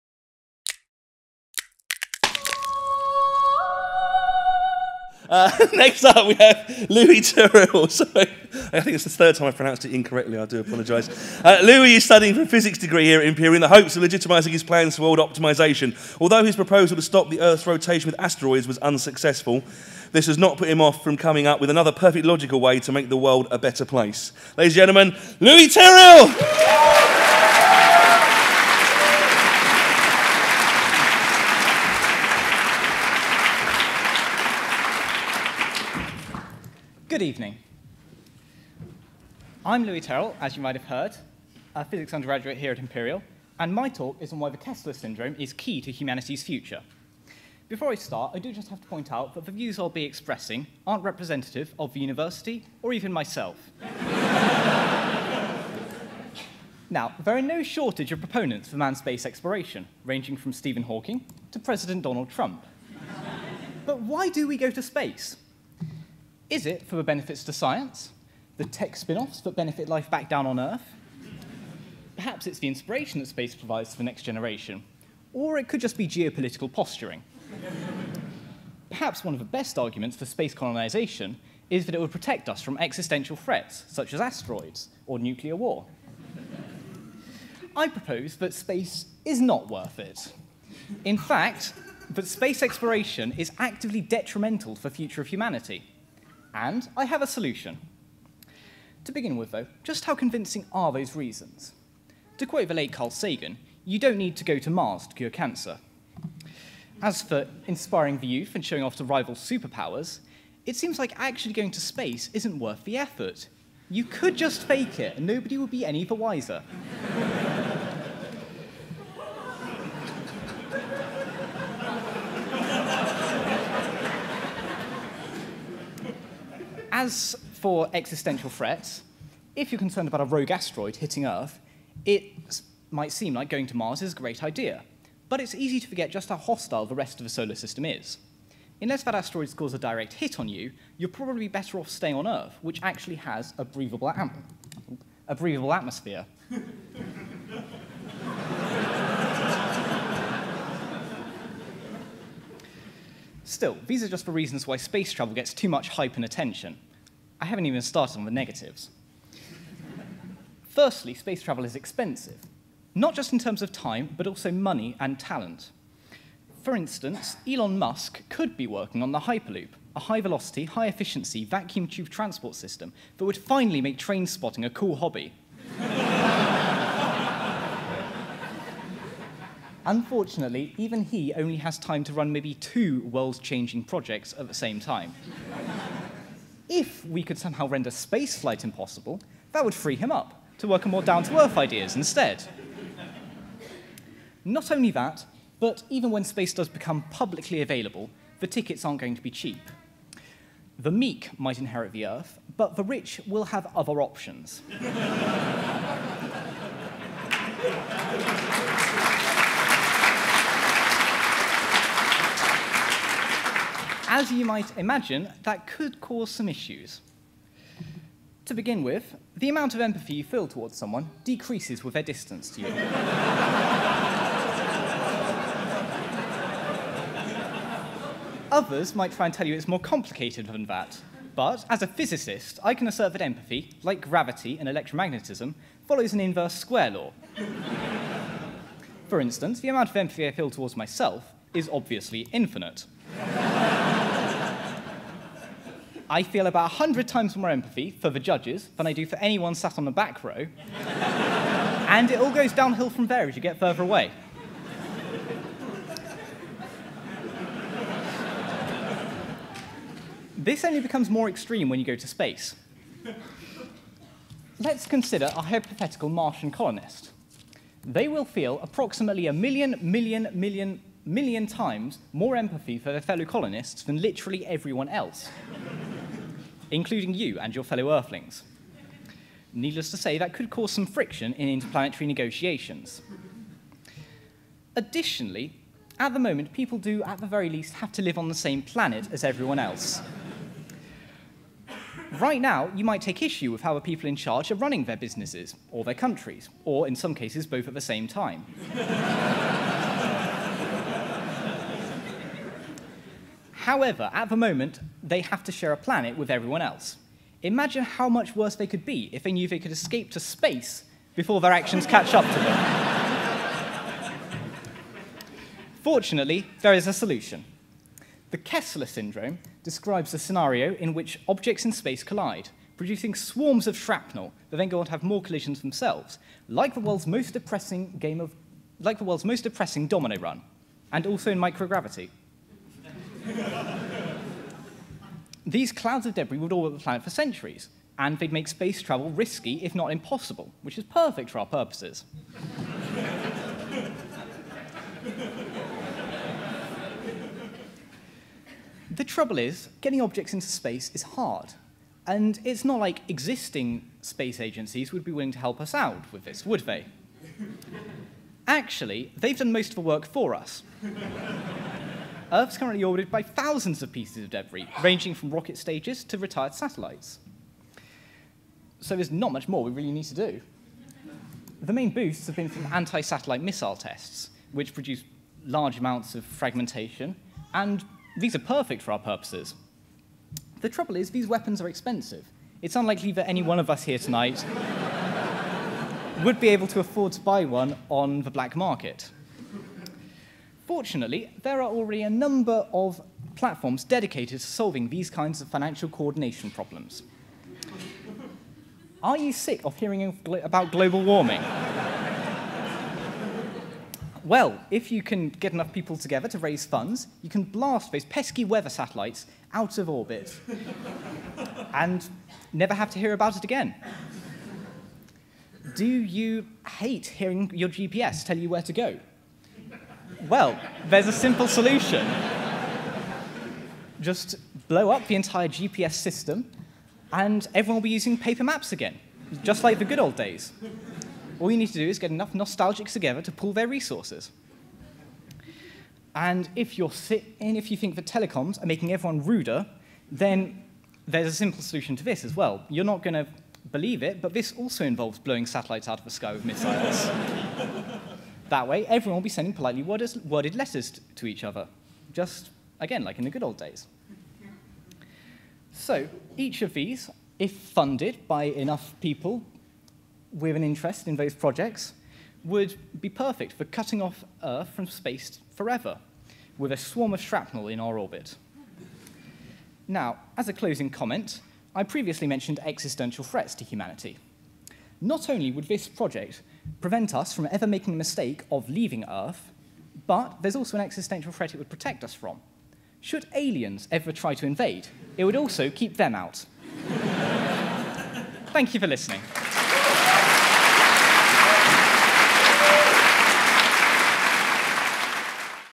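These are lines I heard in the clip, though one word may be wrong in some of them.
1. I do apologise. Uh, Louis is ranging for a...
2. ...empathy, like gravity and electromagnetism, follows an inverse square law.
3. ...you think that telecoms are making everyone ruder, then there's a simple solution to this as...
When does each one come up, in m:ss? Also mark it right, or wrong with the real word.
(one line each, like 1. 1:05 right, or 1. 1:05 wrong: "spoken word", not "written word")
1. 0:10 wrong: "studying", not "ranging"
2. 3:53 right
3. 7:17 right.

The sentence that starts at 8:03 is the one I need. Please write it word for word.
Should aliens ever try to invade, it would also keep them out.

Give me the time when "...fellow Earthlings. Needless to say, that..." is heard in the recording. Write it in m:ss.
4:37.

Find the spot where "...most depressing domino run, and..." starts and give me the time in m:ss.
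5:29.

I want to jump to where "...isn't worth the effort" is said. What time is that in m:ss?
1:52.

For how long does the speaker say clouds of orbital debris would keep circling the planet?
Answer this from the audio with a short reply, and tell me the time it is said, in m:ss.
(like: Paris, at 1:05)
centuries, at 5:37.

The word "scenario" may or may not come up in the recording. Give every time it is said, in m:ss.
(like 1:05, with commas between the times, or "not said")
5:20.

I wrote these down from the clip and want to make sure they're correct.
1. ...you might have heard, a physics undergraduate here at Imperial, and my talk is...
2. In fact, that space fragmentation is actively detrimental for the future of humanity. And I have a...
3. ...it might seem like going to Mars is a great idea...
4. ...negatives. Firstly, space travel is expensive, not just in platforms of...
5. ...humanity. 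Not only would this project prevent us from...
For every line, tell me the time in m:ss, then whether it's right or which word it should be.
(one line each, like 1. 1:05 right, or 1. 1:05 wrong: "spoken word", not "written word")
1. 0:40 right
2. 1:31 wrong: "exploration", not "fragmentation"
3. 2:12 right
4. 2:38 wrong: "terms", not "platforms"
5. 7:53 right.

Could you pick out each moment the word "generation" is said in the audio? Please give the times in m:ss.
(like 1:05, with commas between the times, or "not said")
1:14.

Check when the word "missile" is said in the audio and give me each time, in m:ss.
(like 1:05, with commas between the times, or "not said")
6:13, 7:26.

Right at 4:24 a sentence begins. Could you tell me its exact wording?
Let's consider a hypothetical Martian colonist.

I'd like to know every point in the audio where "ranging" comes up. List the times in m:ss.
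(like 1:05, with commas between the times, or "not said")
1:00, 6:04.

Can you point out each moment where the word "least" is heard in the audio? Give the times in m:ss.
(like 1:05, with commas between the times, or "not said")
4:47.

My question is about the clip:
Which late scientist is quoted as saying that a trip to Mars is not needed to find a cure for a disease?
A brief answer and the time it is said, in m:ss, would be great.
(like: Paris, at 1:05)
Carl Sagan, at 1:42.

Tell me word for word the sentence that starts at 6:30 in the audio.
Fortunately, there are already a number of platforms dedicated to solving these kinds of financial coordination problems.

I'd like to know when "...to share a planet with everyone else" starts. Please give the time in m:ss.
5:05.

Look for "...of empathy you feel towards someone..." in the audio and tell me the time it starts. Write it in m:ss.
3:39.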